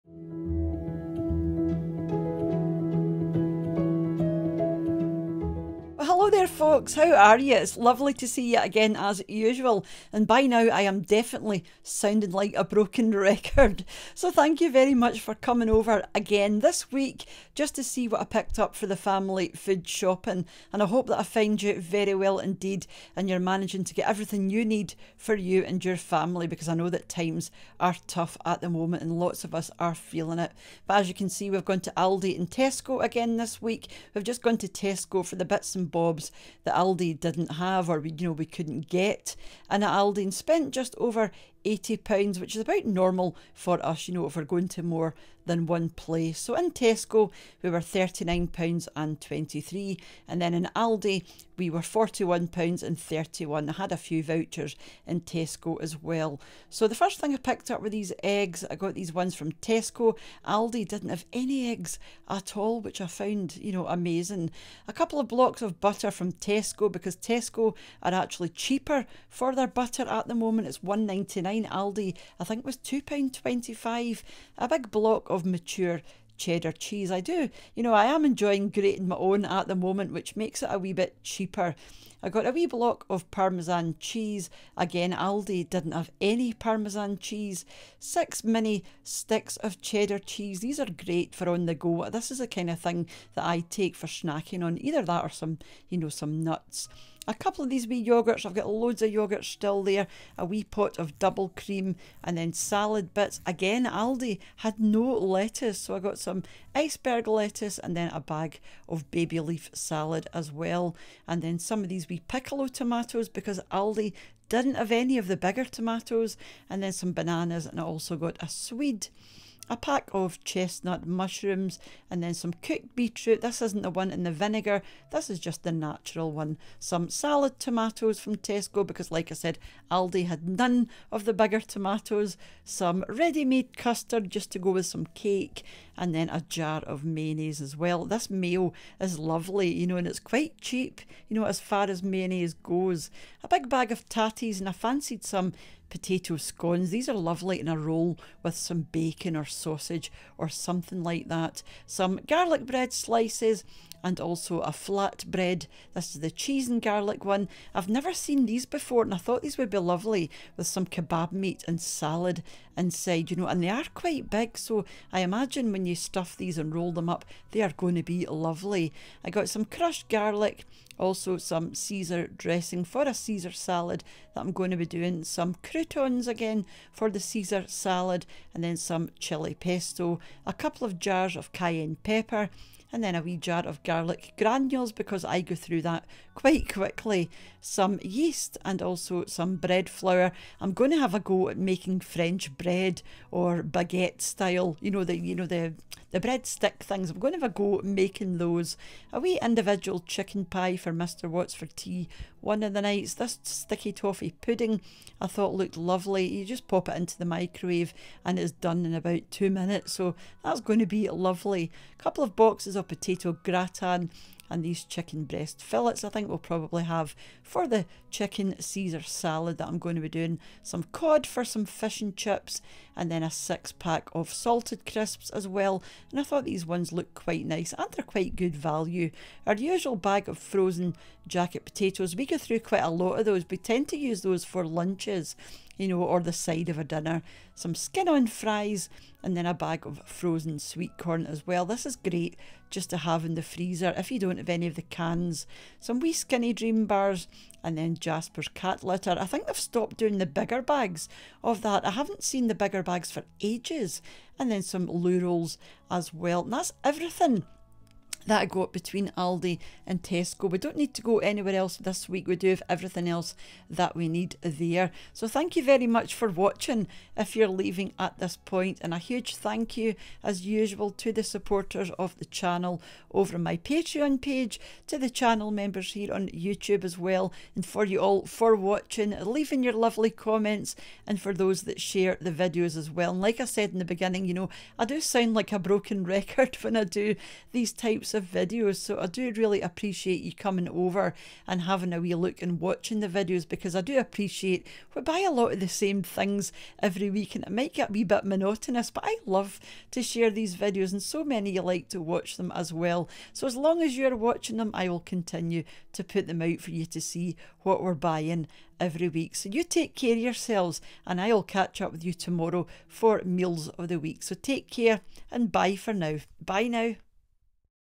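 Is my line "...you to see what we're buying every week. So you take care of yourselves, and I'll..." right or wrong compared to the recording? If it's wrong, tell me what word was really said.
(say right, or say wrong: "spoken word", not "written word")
right.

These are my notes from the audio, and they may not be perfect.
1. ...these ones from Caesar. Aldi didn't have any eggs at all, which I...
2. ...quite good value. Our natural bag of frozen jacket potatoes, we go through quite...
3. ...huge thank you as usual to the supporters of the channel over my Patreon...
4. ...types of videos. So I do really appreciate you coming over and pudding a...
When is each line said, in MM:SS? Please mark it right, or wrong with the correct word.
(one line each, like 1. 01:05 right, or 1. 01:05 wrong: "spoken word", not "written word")
1. 00:58 wrong: "Tesco", not "Caesar"
2. 03:48 wrong: "usual", not "natural"
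3. 04:28 right
4. 04:47 wrong: "having", not "pudding".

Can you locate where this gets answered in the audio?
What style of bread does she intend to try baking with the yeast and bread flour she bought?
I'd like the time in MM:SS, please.
03:12.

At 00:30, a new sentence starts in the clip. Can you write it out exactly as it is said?
But as you can see, we've gone to Aldi and Tesco again this week.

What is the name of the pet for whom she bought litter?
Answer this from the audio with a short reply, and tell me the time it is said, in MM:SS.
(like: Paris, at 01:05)
Jasper, at 04:07.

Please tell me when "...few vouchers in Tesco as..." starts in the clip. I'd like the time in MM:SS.
00:53.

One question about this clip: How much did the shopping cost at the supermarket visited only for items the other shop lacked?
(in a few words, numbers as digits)
£39.23.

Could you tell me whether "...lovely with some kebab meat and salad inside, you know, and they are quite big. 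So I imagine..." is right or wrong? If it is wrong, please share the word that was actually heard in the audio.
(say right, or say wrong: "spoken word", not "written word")
right.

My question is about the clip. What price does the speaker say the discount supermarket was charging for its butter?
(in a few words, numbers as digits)
£2.25.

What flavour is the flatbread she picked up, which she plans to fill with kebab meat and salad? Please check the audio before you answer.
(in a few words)
Cheese and garlic.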